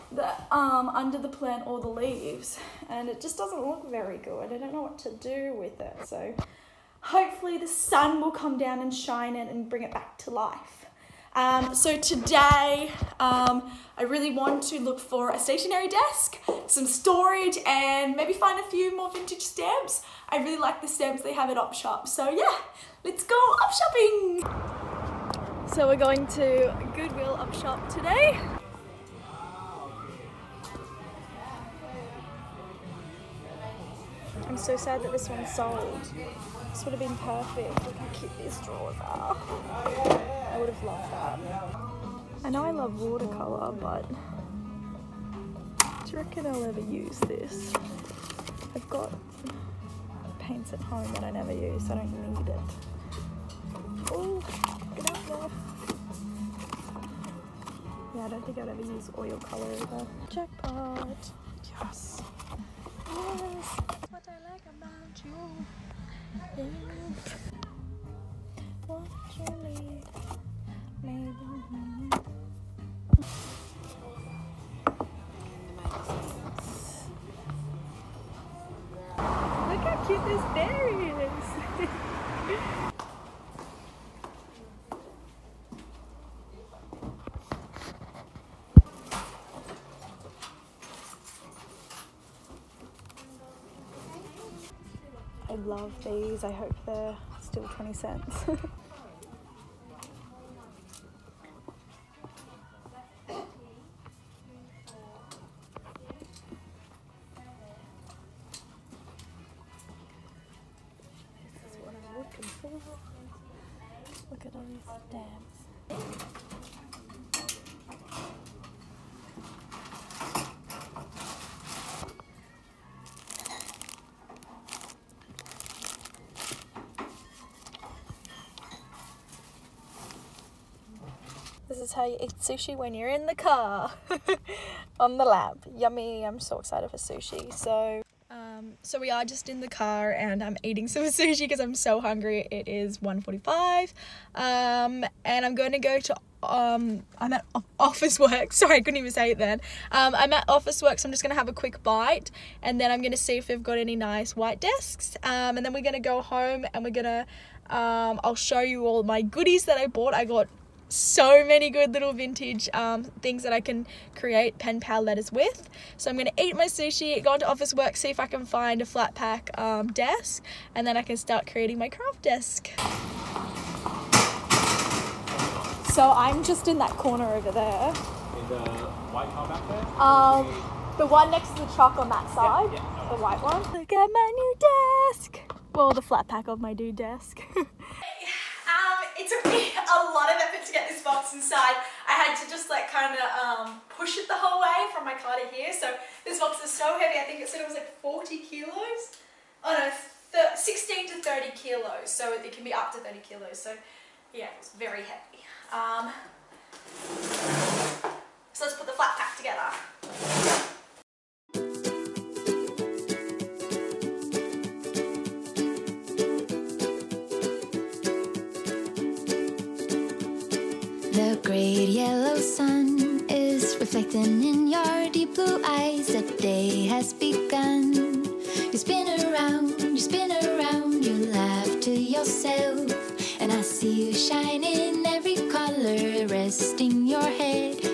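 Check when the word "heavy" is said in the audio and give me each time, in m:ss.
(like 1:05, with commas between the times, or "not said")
3:16, 3:25.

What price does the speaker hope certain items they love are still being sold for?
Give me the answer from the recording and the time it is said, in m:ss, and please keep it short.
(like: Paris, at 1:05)
20 cents, at 1:37.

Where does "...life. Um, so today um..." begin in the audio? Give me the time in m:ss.
0:10.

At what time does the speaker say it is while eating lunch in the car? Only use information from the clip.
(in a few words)
1.45.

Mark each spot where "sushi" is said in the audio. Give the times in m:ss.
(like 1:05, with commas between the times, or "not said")
2:12, 2:16, 2:21, 2:46.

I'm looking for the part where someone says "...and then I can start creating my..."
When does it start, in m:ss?
2:50.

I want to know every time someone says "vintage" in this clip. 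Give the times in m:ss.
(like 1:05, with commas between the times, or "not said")
0:19, 2:42.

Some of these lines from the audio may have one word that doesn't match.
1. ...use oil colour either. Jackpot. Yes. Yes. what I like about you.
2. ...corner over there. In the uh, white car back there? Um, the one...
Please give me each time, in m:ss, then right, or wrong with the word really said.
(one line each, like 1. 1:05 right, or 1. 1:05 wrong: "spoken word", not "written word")
1. 0:58 right
2. 2:56 right.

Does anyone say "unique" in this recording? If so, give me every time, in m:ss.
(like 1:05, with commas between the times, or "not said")
not said.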